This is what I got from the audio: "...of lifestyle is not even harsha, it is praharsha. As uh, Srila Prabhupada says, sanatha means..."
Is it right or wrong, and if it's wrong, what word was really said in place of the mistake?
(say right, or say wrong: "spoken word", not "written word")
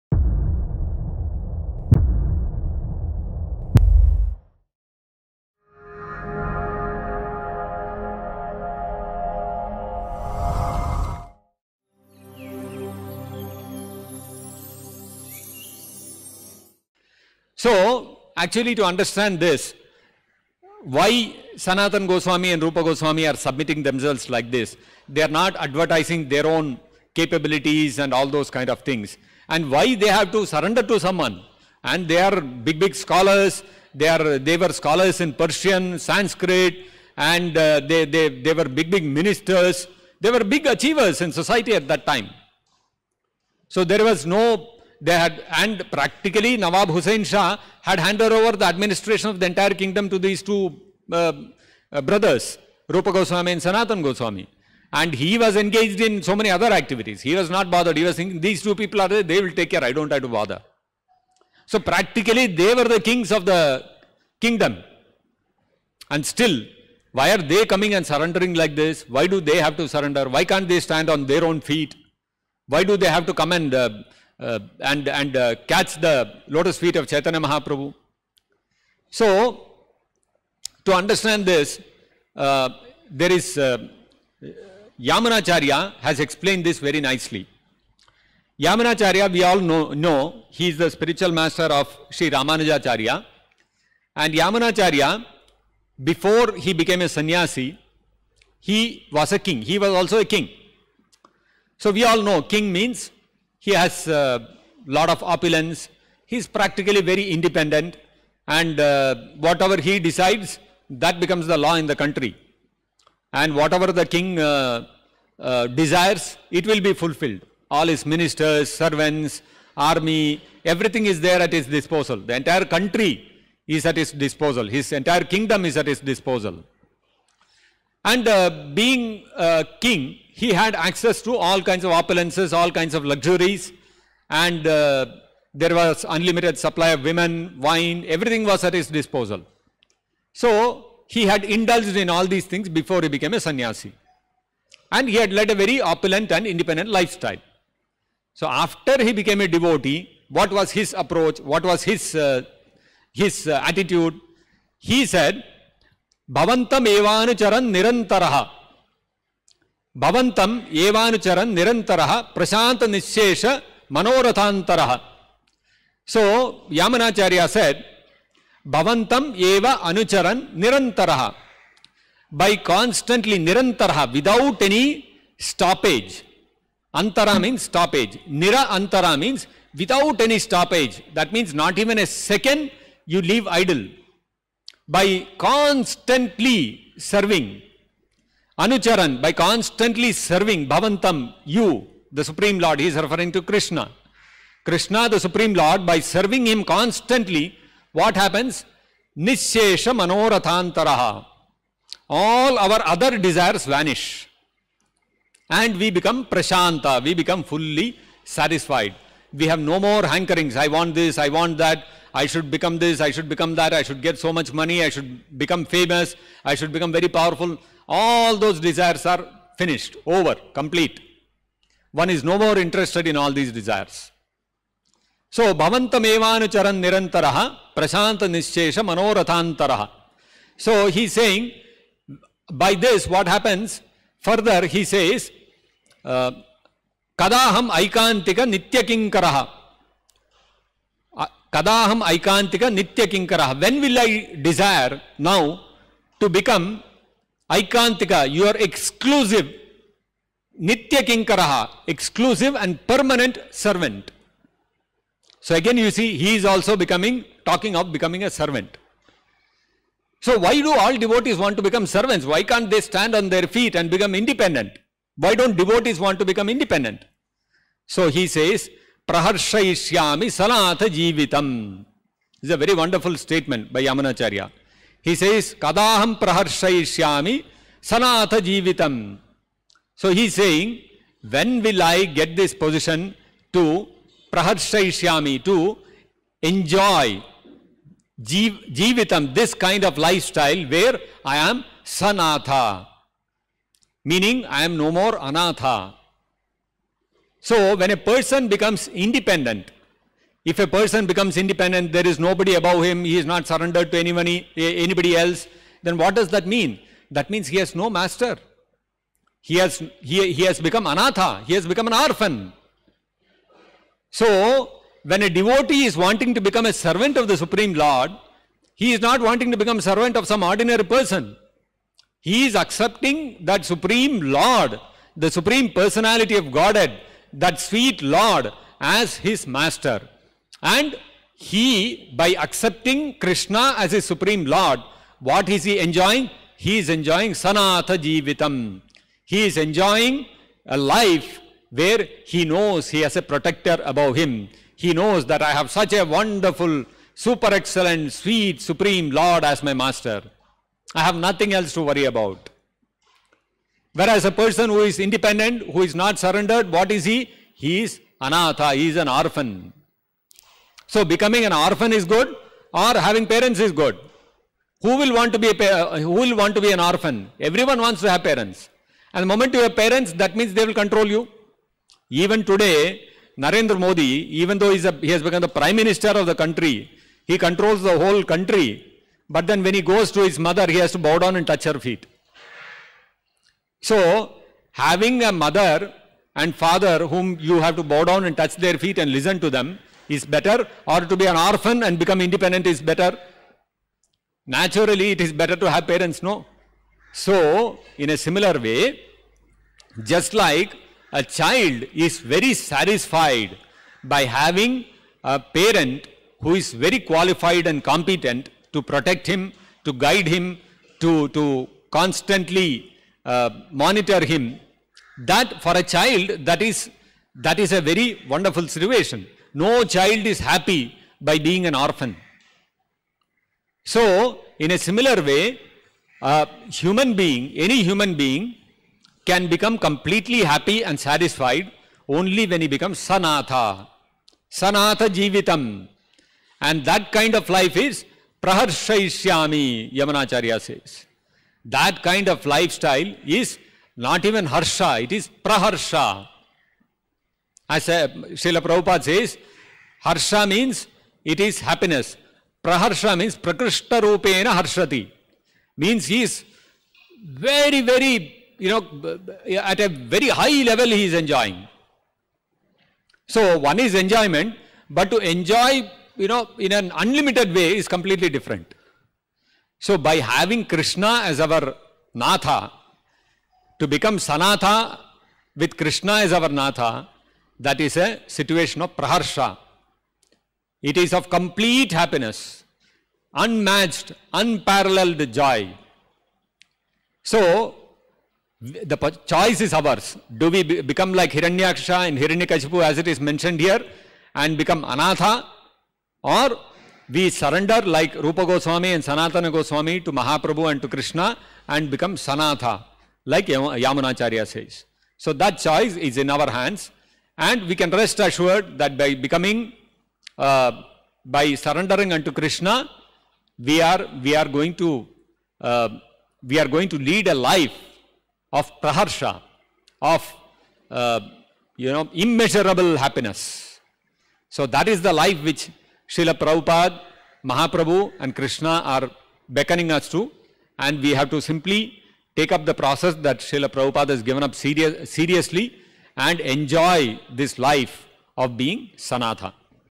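wrong: "harsha", not "sanatha".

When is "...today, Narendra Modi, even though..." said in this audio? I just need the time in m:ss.
6:12.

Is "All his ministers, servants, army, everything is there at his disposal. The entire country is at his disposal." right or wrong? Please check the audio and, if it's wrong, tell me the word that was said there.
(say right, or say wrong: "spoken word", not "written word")
right.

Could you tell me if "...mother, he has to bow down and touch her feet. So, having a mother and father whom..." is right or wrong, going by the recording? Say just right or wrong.
right.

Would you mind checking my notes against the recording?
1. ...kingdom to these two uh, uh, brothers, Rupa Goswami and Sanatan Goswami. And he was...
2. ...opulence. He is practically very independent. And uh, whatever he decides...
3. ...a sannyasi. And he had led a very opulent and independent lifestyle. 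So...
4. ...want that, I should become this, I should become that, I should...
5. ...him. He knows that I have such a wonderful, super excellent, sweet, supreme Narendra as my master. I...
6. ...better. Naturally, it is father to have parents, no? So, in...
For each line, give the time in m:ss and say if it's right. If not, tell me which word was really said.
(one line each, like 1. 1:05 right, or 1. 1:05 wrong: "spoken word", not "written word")
1. 0:49 right
2. 1:45 right
3. 2:23 right
4. 3:31 right
5. 5:44 wrong: "Lord", not "Narendra"
6. 6:32 wrong: "better", not "father".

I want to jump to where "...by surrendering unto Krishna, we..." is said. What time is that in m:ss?
8:31.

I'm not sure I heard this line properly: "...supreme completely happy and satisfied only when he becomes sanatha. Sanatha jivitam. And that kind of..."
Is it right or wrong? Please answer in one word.
wrong.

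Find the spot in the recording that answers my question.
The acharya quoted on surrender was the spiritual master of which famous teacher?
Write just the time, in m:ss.
1:32.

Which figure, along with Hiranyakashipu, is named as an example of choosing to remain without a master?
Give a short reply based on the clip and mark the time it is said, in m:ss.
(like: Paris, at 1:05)
Hiranyaksha, at 8:11.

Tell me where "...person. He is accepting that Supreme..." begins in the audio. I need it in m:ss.
5:20.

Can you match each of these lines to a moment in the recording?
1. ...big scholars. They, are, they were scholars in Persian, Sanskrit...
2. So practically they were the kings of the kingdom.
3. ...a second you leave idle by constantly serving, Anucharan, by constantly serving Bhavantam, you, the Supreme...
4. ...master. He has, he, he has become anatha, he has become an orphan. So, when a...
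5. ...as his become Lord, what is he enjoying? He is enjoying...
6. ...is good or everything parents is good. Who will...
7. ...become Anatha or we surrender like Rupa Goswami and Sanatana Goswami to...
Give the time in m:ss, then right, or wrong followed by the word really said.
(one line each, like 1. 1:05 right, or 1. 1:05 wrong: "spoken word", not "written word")
1. 0:32 right
2. 1:01 right
3. 3:02 right
4. 5:07 right
5. 5:33 wrong: "supreme", not "become"
6. 6:01 wrong: "having", not "everything"
7. 8:14 right.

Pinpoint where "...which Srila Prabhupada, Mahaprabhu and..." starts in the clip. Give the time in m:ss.
8:45.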